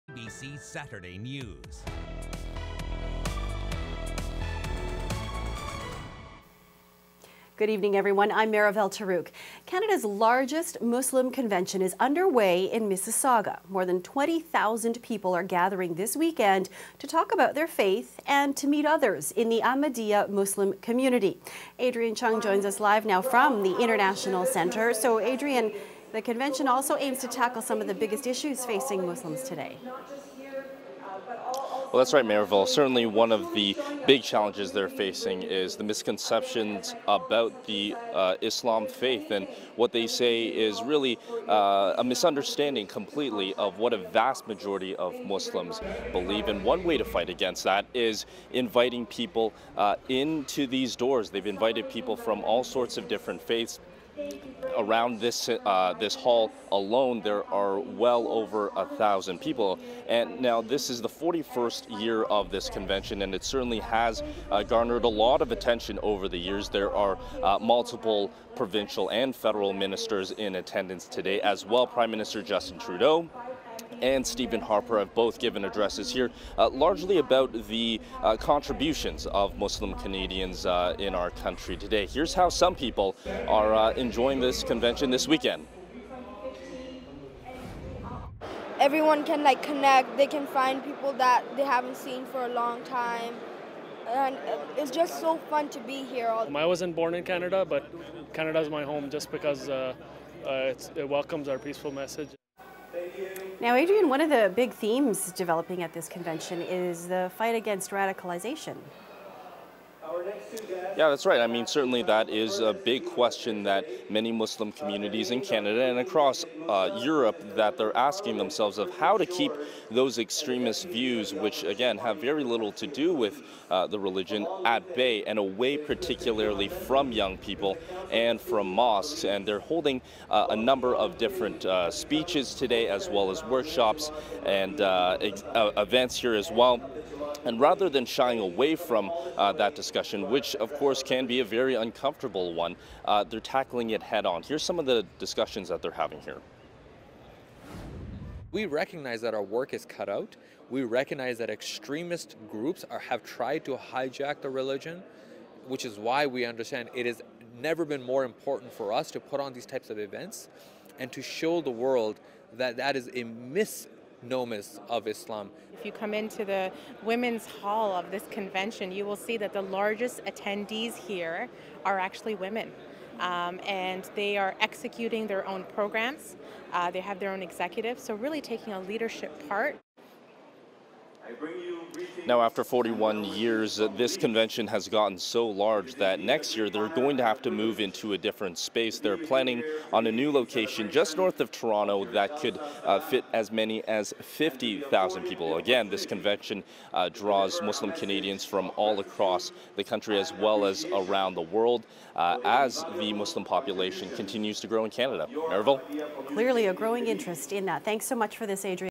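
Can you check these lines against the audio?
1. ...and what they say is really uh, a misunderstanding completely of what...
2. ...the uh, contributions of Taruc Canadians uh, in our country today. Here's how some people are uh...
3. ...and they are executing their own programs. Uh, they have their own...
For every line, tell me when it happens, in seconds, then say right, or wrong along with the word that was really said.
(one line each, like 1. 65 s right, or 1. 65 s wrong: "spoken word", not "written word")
1. 39 s right
2. 77 s wrong: "Muslim", not "Taruc"
3. 173 s right.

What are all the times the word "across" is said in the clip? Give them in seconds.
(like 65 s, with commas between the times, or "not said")
115 s, 198 s.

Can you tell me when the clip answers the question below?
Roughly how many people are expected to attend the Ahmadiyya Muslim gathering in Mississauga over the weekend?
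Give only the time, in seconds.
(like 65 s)
13 s.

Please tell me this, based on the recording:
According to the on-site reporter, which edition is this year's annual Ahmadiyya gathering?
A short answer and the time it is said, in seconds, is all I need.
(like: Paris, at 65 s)
41st, at 61 s.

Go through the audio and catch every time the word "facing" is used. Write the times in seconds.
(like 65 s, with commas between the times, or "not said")
28 s, 34 s.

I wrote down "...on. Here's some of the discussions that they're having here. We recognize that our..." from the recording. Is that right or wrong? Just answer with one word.
right.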